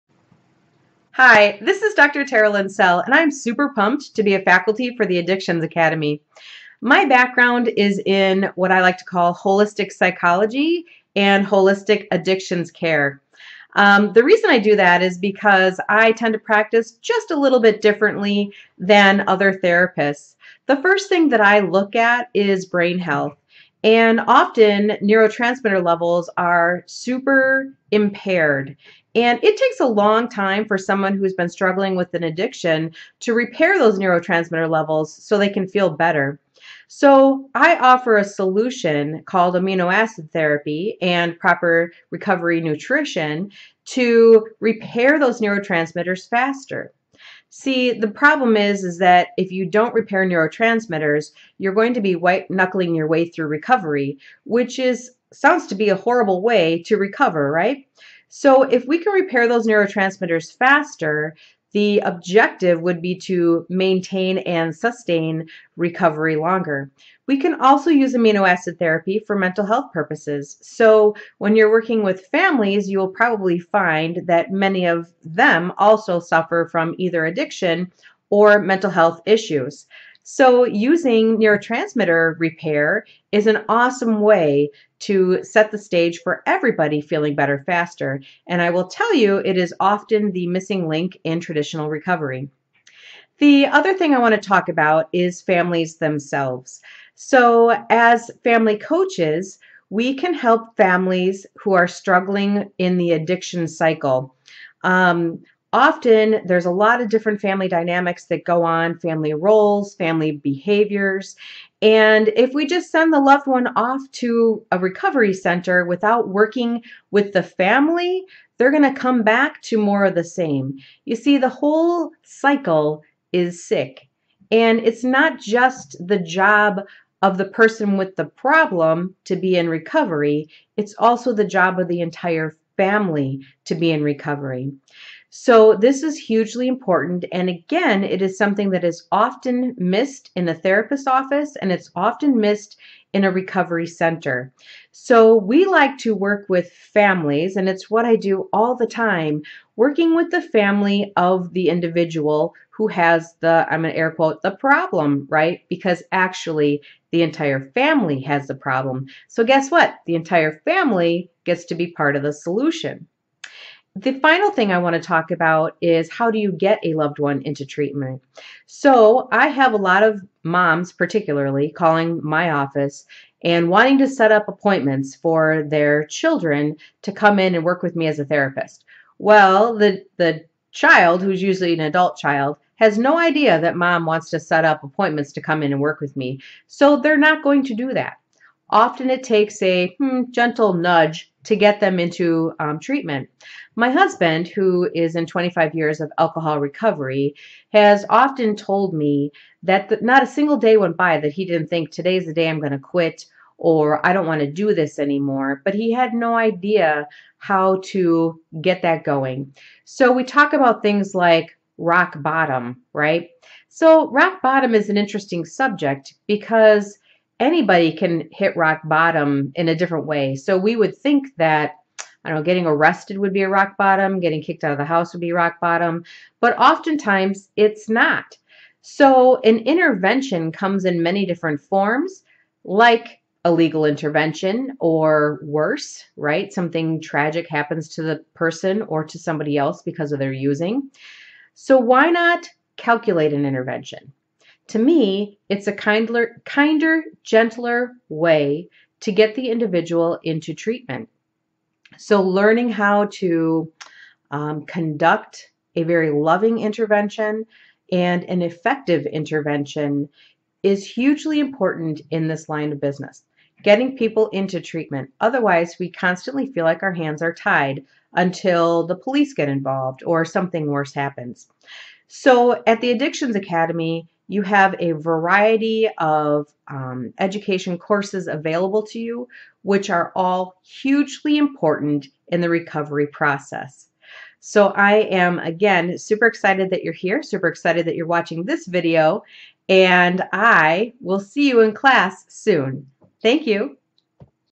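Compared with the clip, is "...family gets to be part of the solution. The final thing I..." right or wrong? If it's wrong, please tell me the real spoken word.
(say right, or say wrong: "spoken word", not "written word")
right.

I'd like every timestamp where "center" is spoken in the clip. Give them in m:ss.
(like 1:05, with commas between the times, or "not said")
1:55, 2:23.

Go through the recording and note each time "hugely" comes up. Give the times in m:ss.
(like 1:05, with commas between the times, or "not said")
2:16, 4:20, 4:40.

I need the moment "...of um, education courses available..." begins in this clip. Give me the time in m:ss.
4:35.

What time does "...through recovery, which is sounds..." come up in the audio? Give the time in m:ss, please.
0:53.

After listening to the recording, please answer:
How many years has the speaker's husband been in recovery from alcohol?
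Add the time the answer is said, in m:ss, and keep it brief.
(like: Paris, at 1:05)
25, at 3:15.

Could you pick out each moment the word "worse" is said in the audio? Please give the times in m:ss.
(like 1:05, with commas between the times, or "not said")
3:55, 4:30.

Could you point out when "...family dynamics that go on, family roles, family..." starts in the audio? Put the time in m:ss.
1:47.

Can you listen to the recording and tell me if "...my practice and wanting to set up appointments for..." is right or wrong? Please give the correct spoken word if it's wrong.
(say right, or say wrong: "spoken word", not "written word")
wrong: "office", not "practice".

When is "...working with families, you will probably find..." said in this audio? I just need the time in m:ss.
1:11.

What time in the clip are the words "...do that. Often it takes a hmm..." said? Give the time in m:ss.
3:07.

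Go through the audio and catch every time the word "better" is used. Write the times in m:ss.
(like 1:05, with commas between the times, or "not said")
0:35, 1:27.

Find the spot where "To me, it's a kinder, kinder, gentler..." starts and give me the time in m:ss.
4:04.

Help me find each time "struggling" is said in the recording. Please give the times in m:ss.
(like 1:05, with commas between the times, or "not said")
0:31, 1:41.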